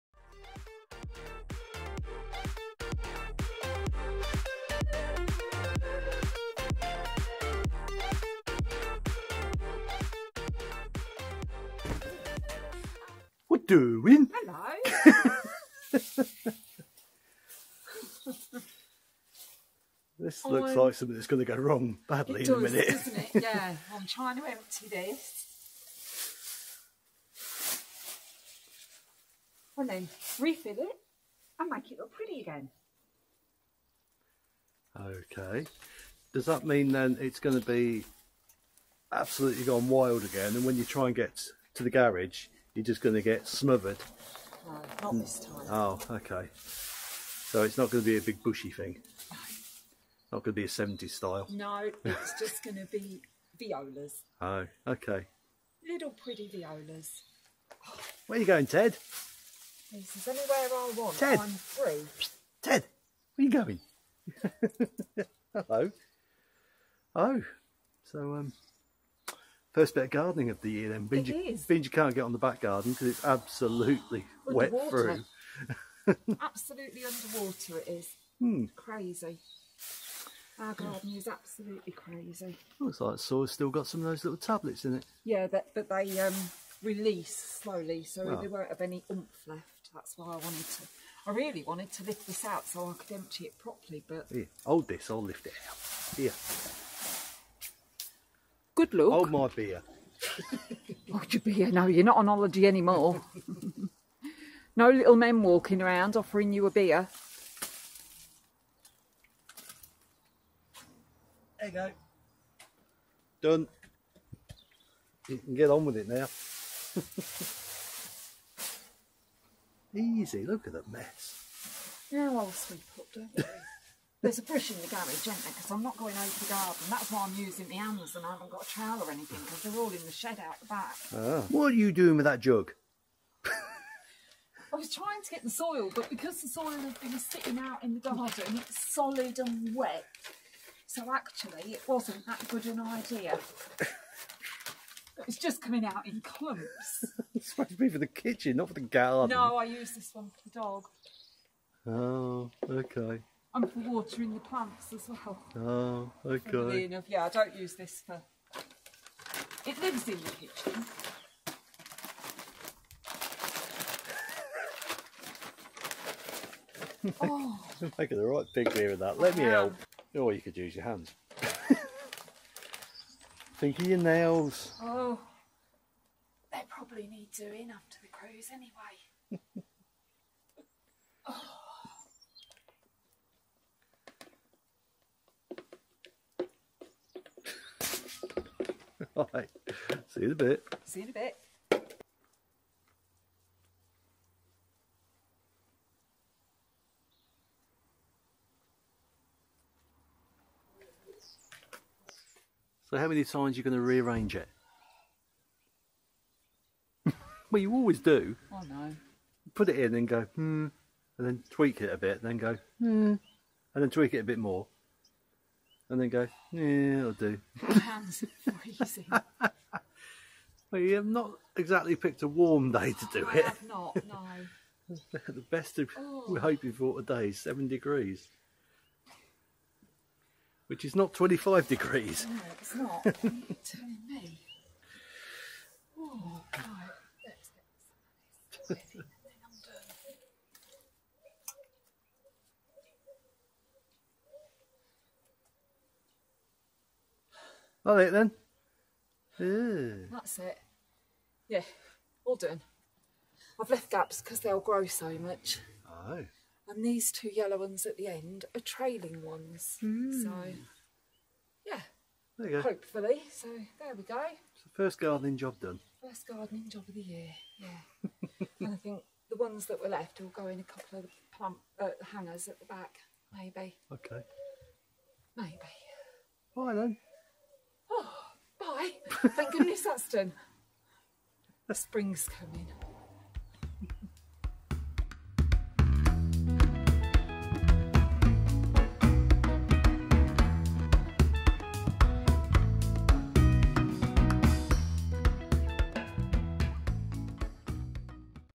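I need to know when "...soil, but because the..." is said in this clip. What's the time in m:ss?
2:15.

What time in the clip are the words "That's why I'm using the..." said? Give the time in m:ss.
2:06.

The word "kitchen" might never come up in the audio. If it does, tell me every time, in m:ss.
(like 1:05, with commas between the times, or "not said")
2:28, 2:40.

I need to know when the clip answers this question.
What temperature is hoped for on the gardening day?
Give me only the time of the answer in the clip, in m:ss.
3:47.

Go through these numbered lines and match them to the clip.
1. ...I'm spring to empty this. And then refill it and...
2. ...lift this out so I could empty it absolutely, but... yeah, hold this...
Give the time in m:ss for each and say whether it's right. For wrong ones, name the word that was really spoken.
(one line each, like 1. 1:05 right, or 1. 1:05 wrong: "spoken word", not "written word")
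1. 0:23 wrong: "trying", not "spring"
2. 1:32 wrong: "properly", not "absolutely".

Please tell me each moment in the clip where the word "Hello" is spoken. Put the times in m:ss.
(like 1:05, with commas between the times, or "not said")
0:14, 1:05.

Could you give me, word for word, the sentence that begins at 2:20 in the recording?
So actually, it wasn't that good an idea.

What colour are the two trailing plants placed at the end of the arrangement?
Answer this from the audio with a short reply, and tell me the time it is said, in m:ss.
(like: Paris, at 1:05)
yellow, at 4:17.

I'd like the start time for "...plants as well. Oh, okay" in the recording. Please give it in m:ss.
2:34.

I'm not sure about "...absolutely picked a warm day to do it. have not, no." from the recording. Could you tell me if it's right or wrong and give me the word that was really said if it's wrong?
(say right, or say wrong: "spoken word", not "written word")
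wrong: "exactly", not "absolutely".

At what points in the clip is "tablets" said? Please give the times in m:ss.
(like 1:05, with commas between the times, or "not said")
1:24.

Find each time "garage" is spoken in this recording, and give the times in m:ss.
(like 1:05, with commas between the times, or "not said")
0:41, 2:04.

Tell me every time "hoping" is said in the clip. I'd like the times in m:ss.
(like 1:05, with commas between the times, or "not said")
3:46.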